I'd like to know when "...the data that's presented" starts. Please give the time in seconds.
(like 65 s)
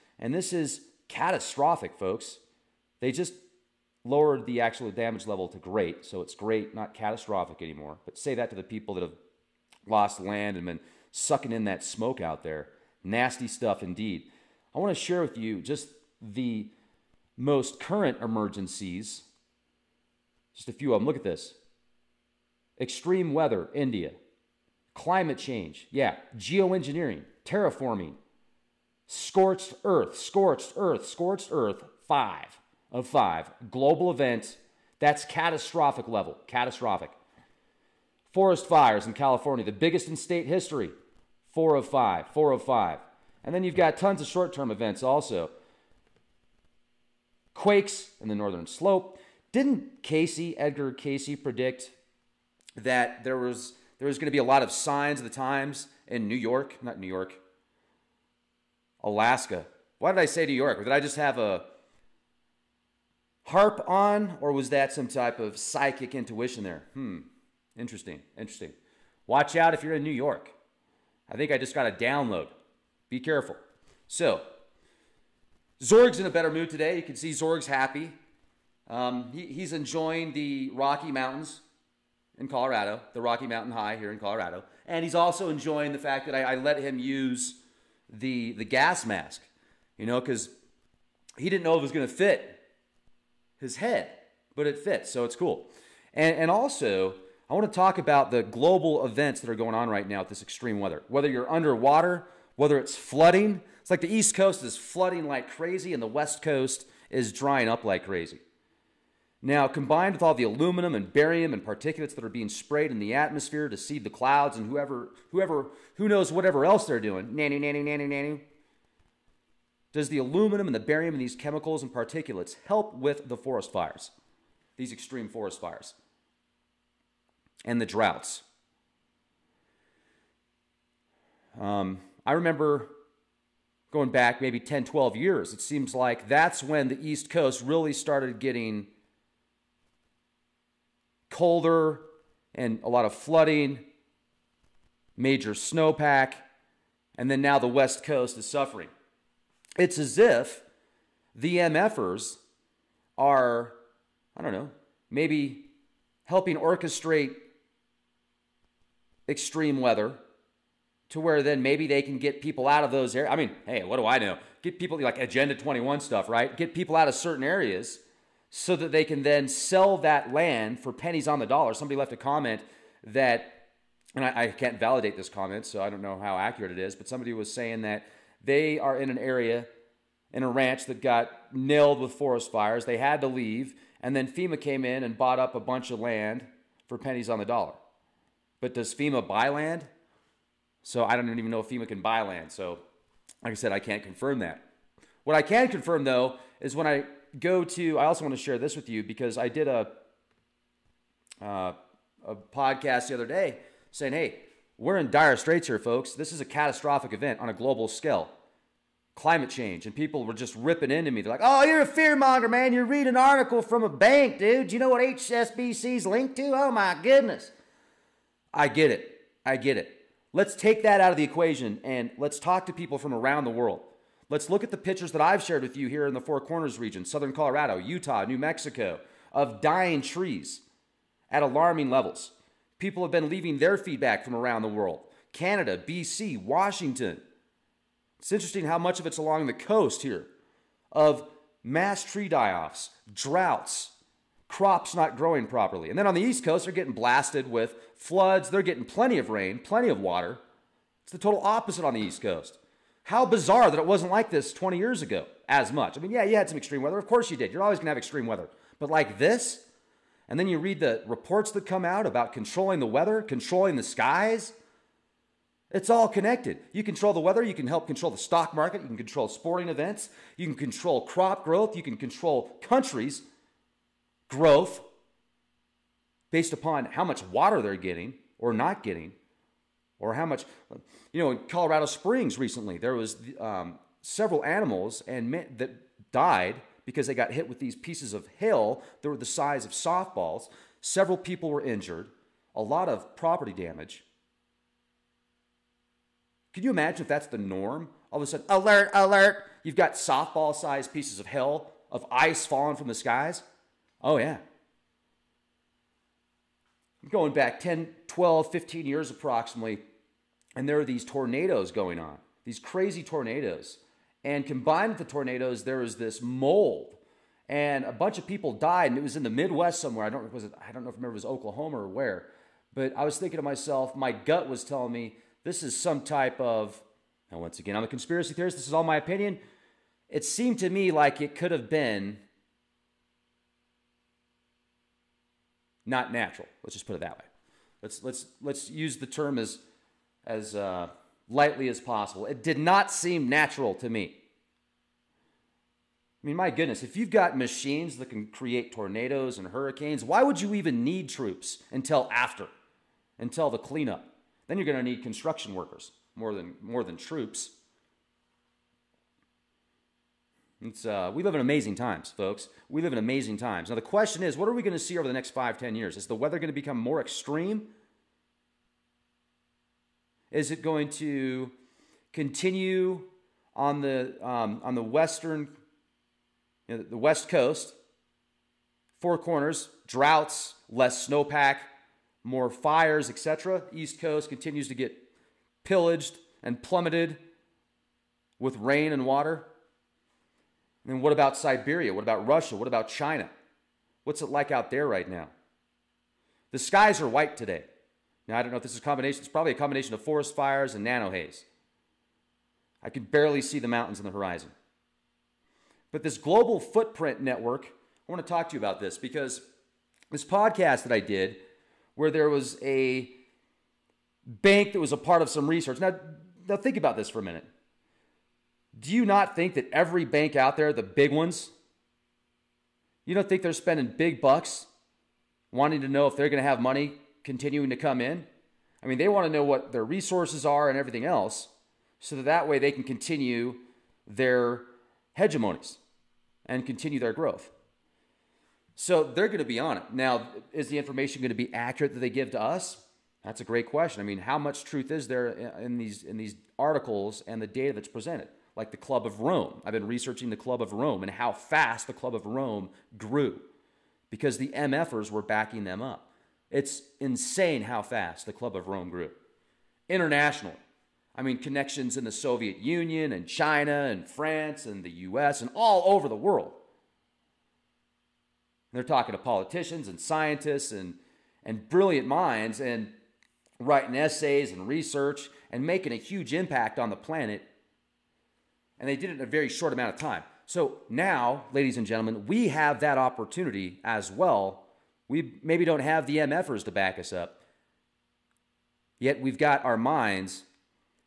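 447 s.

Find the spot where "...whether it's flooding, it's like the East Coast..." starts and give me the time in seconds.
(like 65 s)
102 s.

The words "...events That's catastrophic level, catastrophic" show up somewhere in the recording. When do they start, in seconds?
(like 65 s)
34 s.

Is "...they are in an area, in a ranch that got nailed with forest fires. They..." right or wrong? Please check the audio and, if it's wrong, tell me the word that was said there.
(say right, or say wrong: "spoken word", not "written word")
right.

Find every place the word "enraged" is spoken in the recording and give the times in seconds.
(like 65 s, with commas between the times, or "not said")
not said.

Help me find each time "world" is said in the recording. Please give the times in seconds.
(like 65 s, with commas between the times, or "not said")
223 s, 234 s, 466 s.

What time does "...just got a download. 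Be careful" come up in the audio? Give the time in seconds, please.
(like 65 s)
71 s.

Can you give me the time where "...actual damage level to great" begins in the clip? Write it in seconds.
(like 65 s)
4 s.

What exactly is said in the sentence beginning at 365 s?
Is the weather going to become more extreme?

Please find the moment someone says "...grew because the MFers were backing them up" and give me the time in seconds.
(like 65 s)
452 s.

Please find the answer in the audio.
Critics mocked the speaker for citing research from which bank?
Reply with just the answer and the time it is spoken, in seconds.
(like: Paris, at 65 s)
HSBC, at 215 s.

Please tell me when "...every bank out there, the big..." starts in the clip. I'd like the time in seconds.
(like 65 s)
419 s.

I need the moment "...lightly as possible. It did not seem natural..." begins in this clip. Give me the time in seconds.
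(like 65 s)
341 s.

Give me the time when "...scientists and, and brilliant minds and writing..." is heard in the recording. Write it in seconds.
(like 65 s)
469 s.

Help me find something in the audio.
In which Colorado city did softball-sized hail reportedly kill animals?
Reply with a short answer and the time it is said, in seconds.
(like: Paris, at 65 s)
Colorado Springs, at 281 s.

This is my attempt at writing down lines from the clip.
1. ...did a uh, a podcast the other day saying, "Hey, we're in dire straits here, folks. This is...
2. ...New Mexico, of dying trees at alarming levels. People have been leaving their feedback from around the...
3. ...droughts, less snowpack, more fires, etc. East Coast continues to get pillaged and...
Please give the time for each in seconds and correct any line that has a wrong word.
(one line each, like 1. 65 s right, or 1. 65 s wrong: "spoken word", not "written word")
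1. 199 s right
2. 228 s right
3. 379 s right.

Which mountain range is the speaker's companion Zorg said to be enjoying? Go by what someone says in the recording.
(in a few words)
Rocky Mountains.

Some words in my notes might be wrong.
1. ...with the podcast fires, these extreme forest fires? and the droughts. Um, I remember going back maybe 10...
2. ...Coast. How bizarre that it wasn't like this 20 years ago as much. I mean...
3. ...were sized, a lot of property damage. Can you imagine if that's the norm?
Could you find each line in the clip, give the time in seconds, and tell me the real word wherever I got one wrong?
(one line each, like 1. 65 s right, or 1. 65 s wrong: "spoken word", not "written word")
1. 122 s wrong: "forest", not "podcast"
2. 252 s right
3. 291 s wrong: "injured", not "sized".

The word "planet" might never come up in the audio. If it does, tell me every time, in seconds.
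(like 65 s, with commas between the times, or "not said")
476 s.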